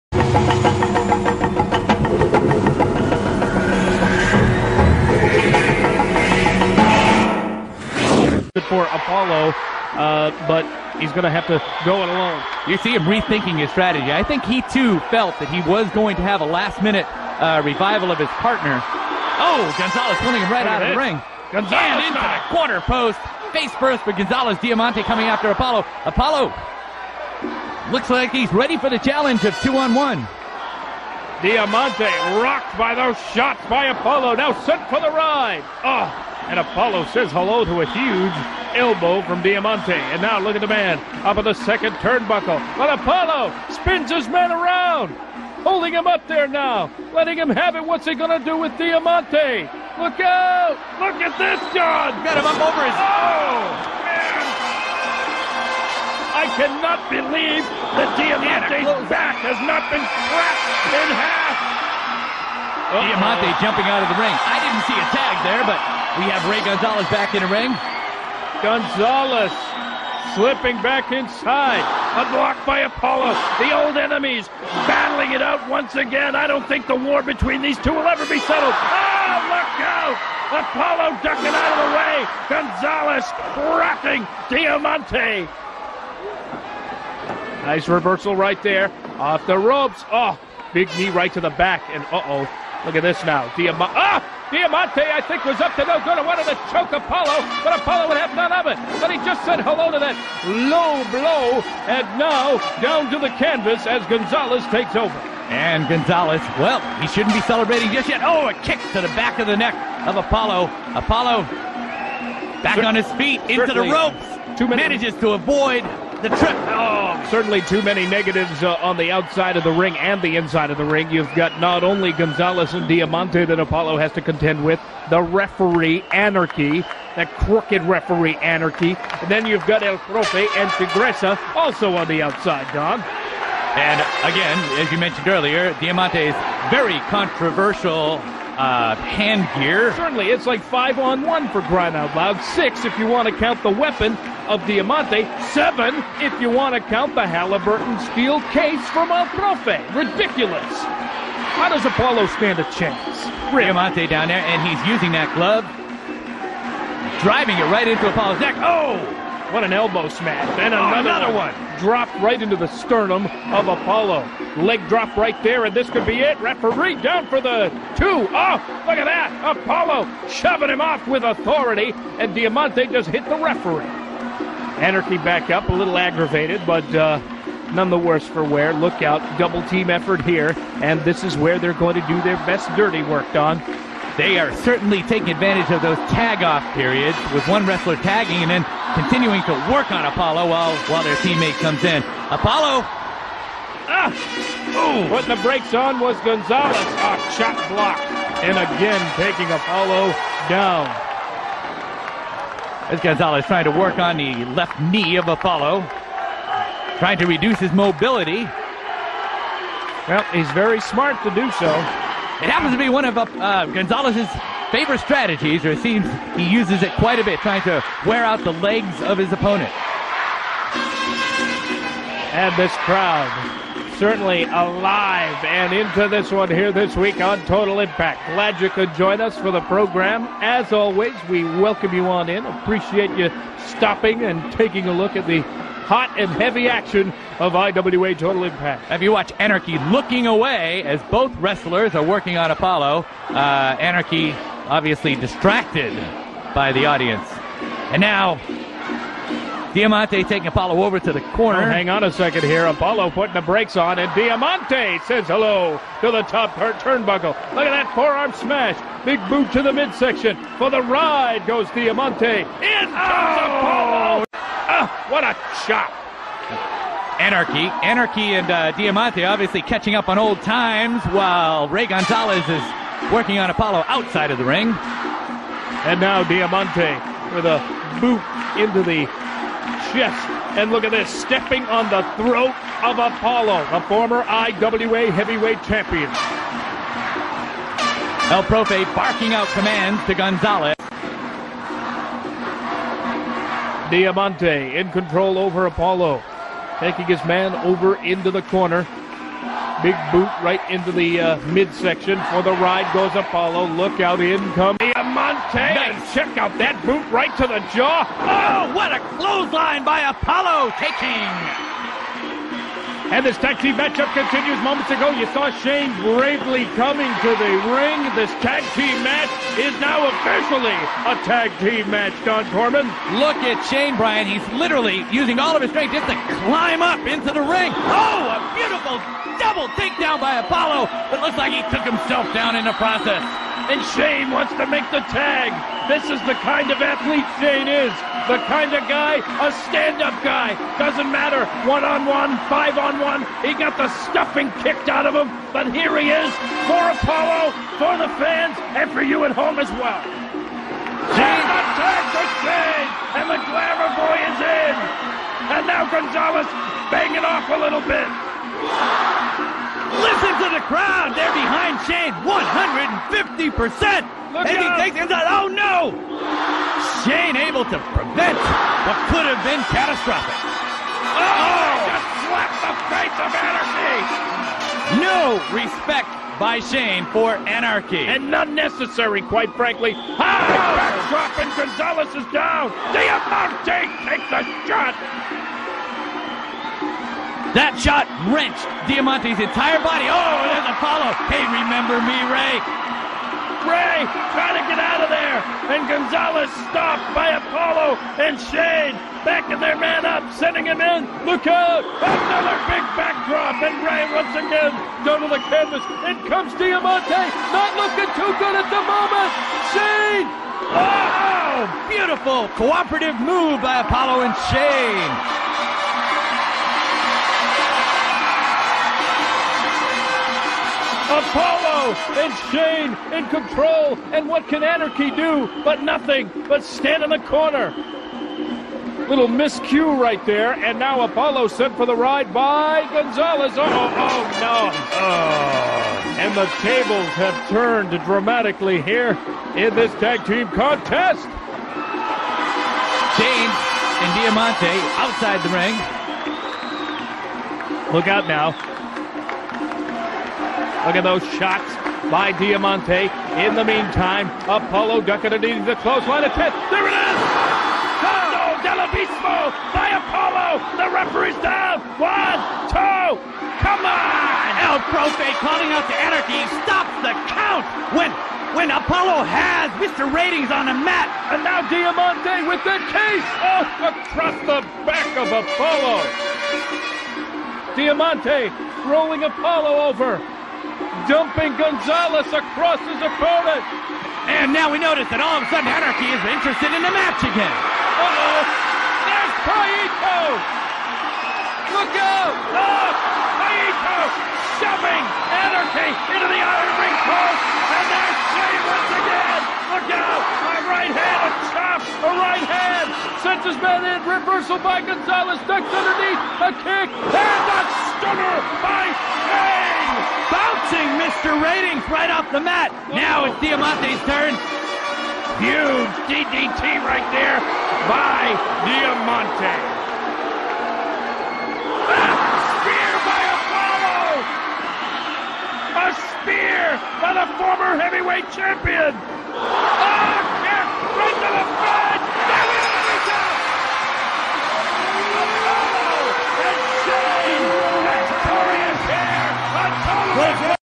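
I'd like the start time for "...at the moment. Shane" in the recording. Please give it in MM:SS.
06:48.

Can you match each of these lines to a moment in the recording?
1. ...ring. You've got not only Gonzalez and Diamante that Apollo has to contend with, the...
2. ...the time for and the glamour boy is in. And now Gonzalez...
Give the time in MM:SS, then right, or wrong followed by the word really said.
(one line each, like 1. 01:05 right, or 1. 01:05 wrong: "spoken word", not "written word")
1. 02:00 right
2. 05:51 right.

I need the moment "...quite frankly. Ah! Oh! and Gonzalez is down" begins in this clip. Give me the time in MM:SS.
06:19.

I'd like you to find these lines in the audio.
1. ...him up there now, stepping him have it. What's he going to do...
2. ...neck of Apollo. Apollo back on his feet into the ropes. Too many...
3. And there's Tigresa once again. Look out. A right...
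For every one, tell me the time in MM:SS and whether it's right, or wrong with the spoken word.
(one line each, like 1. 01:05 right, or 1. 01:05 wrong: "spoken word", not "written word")
1. 00:45 wrong: "letting", not "stepping"
2. 01:49 right
3. 08:17 wrong: "Jay", not "Tigresa".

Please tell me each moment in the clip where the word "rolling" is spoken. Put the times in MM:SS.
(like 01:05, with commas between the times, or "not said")
07:58.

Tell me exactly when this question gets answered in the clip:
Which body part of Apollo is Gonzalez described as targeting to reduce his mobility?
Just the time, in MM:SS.
03:24.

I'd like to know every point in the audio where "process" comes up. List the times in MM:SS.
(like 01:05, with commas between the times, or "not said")
05:32.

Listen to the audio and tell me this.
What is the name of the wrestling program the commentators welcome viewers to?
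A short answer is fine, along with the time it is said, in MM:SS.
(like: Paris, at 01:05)
IWA Total Impact, at 03:57.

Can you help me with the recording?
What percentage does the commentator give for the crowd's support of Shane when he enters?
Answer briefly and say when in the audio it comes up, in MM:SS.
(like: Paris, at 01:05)
150%, at 06:02.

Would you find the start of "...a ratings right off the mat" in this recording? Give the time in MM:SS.
08:27.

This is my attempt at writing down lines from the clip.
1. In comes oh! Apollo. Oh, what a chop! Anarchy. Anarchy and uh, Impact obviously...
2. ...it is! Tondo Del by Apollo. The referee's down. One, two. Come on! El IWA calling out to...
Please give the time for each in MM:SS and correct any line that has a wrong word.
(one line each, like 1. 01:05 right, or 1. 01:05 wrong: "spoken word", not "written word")
1. 04:22 wrong: "Diamante", not "Impact"
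2. 07:36 wrong: "Profe", not "IWA".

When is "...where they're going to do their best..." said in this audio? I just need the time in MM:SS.
03:01.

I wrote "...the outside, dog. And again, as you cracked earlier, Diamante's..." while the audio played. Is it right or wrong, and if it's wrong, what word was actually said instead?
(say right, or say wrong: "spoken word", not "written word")
wrong: "mentioned", not "cracked".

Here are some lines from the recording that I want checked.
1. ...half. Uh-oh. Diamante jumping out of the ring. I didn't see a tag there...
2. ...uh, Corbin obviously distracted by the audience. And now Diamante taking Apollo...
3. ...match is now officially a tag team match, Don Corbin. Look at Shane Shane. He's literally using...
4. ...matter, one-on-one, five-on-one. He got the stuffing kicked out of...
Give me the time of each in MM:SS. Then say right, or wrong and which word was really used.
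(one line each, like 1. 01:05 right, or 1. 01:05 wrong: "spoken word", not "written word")
1. 01:01 right
2. 04:03 wrong: "Anarchy", not "Corbin"
3. 05:19 wrong: "Bryan", not "Shane"
4. 05:41 right.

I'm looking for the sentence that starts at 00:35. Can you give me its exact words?
Oh, and Apollo says hello to a huge elbow from Diamante.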